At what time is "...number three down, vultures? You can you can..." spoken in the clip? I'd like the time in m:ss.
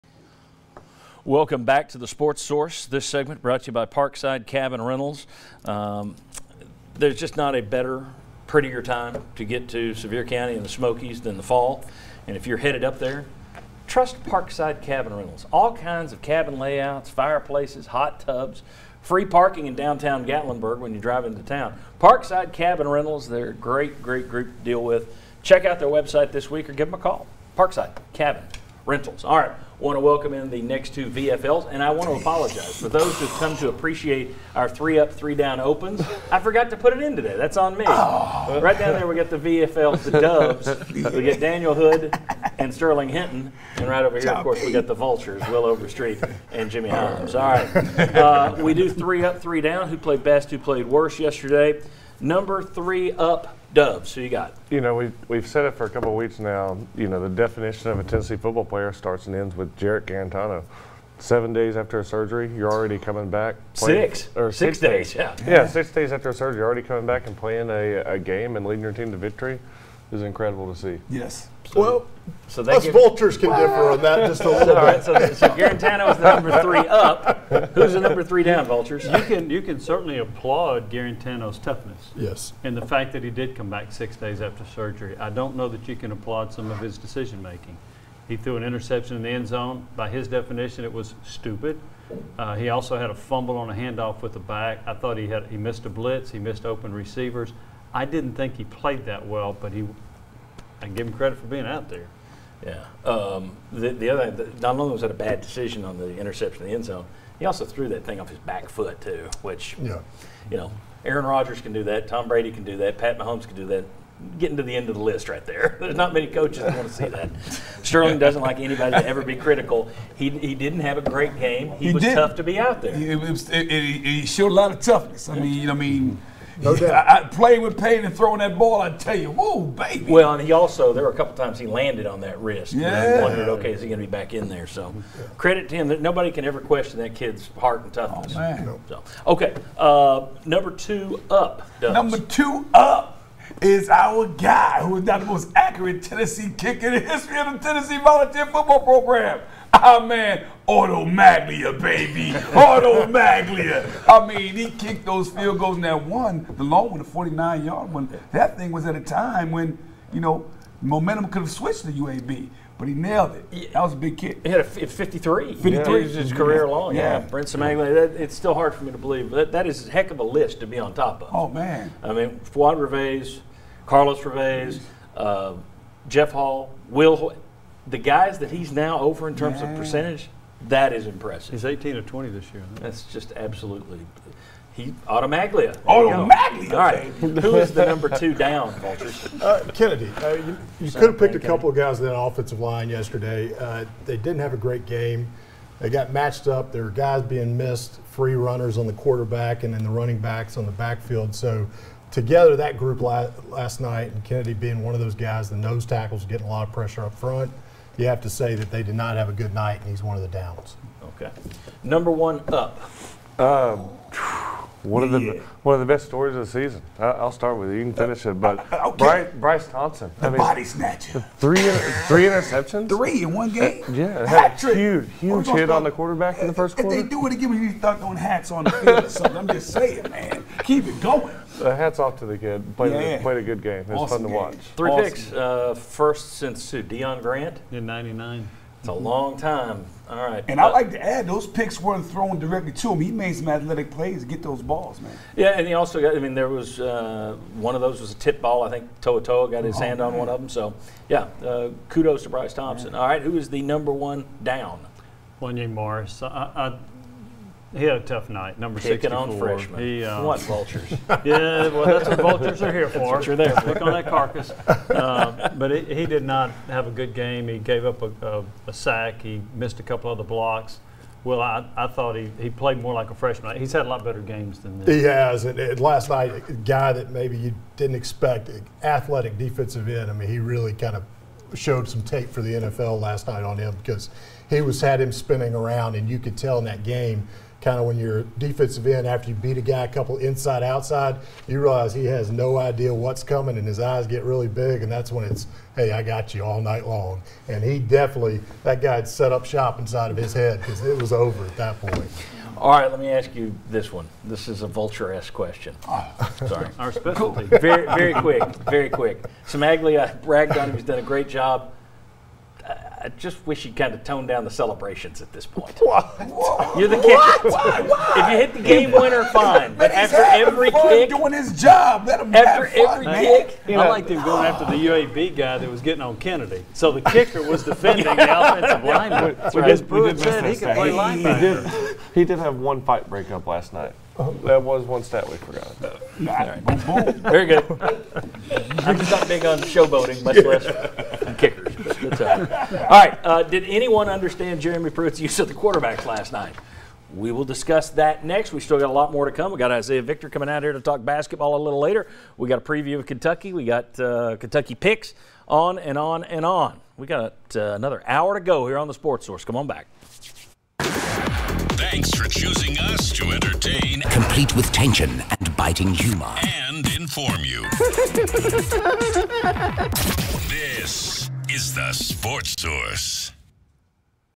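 1:18.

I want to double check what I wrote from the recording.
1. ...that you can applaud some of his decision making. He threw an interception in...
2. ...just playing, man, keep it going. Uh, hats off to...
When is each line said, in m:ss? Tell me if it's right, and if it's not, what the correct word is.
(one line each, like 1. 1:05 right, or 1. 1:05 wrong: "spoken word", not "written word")
1. 1:25 right
2. 3:49 wrong: "saying", not "playing".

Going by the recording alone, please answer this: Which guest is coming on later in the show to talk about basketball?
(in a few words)
Isaiah Victor.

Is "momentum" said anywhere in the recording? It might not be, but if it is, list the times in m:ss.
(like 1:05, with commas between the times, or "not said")
2:40.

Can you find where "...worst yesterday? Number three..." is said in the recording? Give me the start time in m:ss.
0:50.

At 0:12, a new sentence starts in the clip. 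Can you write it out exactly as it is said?
And if you're headed up there, trust Parkside Cabin Rentals.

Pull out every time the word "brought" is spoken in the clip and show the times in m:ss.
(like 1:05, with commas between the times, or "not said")
0:03.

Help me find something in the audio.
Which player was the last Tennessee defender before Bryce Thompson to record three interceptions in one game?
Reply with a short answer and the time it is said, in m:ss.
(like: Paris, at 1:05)
Deon Grant, at 3:56.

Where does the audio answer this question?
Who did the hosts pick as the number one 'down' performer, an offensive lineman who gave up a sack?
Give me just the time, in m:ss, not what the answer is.
4:15.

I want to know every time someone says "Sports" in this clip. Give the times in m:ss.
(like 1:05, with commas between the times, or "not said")
0:02, 5:58, 6:11.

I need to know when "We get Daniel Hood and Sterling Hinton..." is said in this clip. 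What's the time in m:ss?
0:41.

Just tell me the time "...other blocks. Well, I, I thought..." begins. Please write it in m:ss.
4:30.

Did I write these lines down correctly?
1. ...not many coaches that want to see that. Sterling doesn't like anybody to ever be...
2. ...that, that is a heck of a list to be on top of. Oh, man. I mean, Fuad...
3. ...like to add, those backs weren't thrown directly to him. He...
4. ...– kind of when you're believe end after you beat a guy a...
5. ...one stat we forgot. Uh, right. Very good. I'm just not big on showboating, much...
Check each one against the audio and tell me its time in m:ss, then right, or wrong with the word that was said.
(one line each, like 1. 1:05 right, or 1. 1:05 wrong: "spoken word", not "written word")
1. 1:55 right
2. 2:49 right
3. 4:00 wrong: "picks", not "backs"
4. 4:47 wrong: "defensive", not "believe"
5. 5:34 right.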